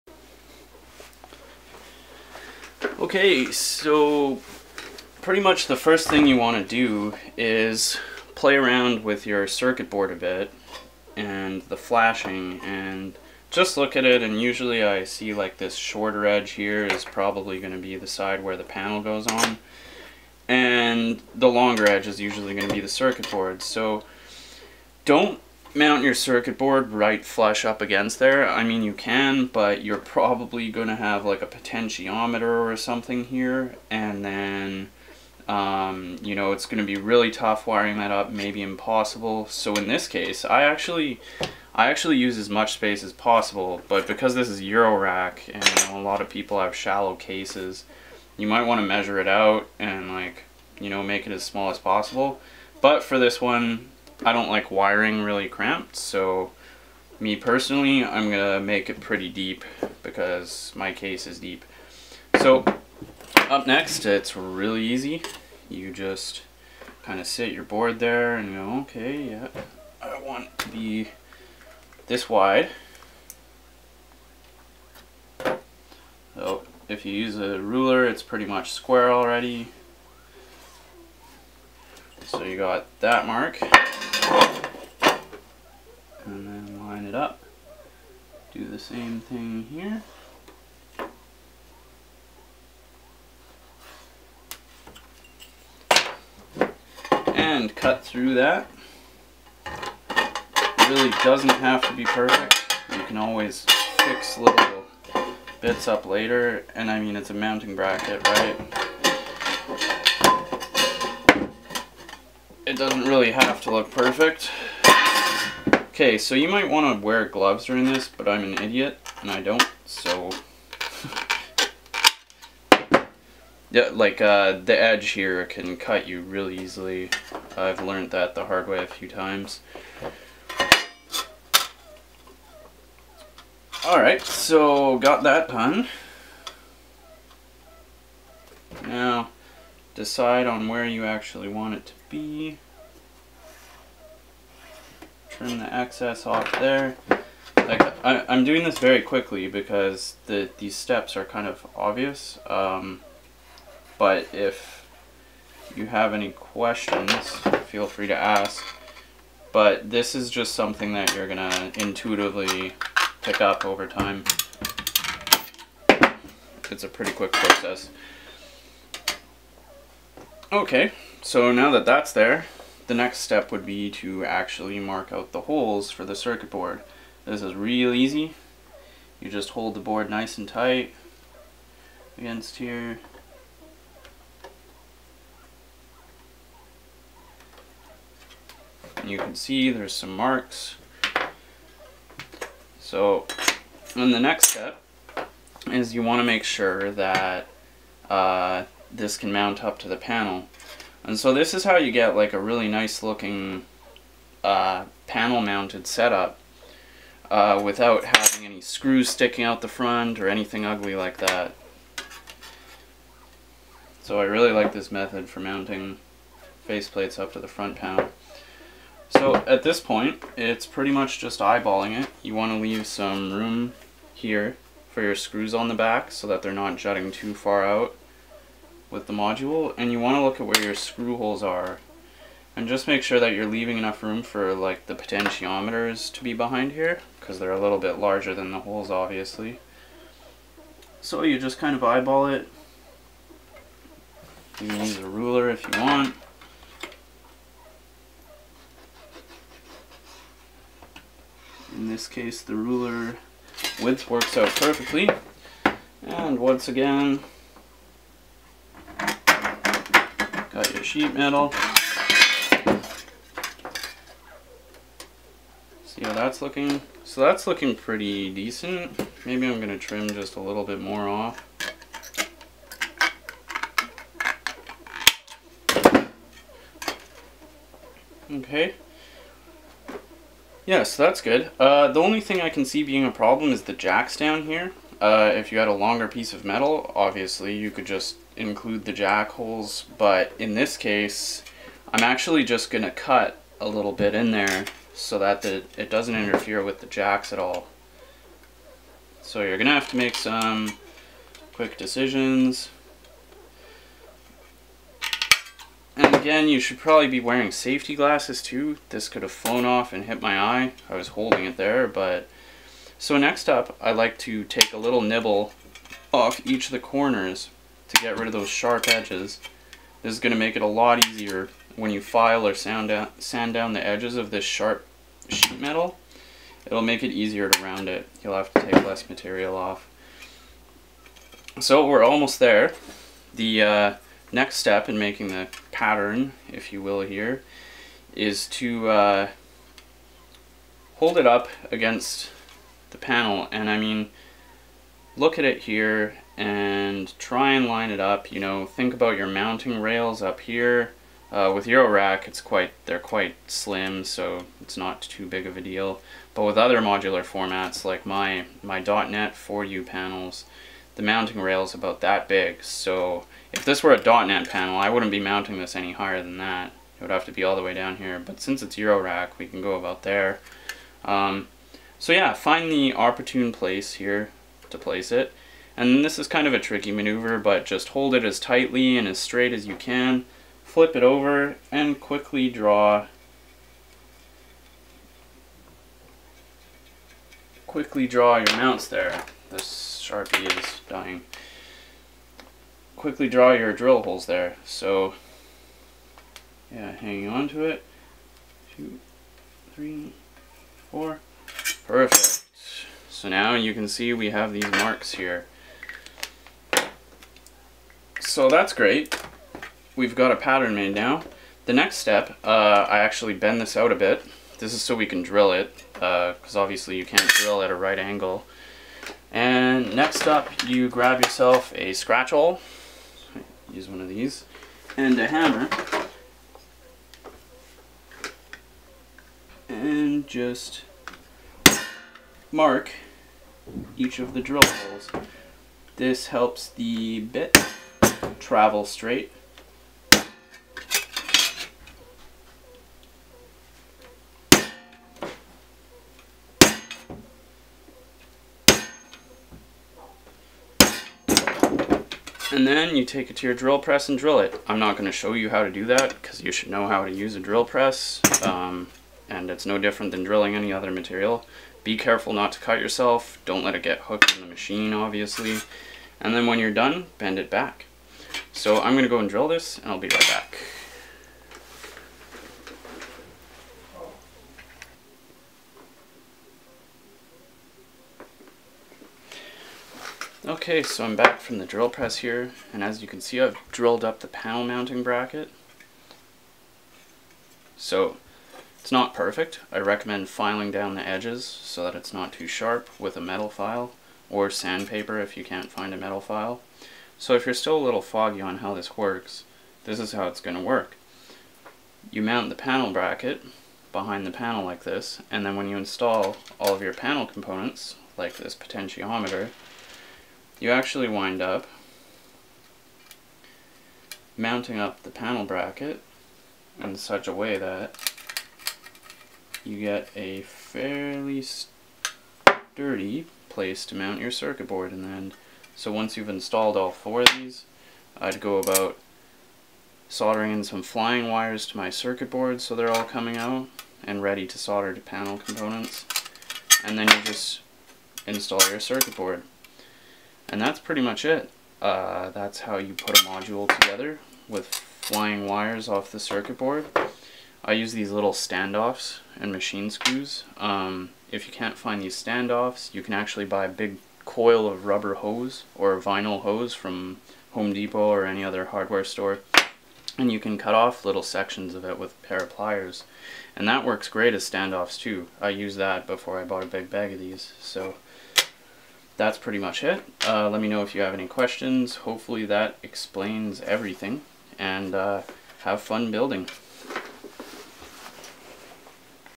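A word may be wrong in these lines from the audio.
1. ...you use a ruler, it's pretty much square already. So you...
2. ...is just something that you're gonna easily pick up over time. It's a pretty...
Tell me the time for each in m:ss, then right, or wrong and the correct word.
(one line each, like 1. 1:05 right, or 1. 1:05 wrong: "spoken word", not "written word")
1. 1:17 right
2. 2:40 wrong: "intuitively", not "easily".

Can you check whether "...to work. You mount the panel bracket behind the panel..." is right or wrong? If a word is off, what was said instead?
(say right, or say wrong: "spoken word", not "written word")
right.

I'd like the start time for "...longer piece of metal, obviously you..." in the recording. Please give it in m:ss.
4:45.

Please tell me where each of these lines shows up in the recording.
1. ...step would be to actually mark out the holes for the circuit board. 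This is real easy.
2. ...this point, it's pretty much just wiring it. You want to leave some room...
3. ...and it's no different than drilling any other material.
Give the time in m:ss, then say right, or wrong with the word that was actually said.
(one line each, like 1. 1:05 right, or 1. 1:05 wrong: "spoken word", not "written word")
1. 2:53 right
2. 3:39 wrong: "eyeballing", not "wiring"
3. 7:39 right.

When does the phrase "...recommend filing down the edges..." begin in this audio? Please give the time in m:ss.
8:09.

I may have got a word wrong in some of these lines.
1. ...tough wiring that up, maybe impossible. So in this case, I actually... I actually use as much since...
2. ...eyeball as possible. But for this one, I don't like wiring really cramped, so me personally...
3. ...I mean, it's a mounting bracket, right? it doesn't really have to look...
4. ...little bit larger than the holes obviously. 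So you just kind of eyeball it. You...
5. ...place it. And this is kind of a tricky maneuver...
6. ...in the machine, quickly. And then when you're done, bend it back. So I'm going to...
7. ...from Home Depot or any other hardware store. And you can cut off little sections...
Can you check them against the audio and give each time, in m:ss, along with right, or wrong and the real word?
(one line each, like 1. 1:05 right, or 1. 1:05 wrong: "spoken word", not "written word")
1. 0:37 wrong: "space", not "since"
2. 0:51 wrong: "small", not "eyeball"
3. 1:46 right
4. 3:57 right
5. 6:14 right
6. 7:44 wrong: "obviously", not "quickly"
7. 9:16 right.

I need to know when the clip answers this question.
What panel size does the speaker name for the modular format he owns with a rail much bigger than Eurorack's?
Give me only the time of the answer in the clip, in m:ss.
5:59.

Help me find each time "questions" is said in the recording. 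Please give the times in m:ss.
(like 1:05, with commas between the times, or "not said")
2:36, 9:31.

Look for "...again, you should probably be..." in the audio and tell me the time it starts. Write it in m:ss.
5:06.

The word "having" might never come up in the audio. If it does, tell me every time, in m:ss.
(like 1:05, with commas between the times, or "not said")
3:28.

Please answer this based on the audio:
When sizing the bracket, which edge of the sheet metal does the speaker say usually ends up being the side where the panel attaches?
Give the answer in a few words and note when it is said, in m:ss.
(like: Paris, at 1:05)
shorter edge, at 0:15.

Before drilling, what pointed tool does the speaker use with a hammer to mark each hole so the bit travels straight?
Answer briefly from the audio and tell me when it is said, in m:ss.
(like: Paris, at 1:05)
scratch awl, at 7:01.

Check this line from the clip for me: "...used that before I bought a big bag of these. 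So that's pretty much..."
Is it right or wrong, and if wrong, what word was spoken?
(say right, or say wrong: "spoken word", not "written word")
right.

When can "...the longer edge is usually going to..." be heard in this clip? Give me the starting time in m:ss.
0:21.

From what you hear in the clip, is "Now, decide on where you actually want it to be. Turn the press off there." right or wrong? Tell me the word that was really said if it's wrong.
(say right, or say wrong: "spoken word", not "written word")
wrong: "excess", not "press".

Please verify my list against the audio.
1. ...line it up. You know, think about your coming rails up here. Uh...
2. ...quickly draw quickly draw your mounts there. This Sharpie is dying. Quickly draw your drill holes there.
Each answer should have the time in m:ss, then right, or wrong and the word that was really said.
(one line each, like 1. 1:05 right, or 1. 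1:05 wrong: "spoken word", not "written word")
1. 5:47 wrong: "mounting", not "coming"
2. 6:21 right.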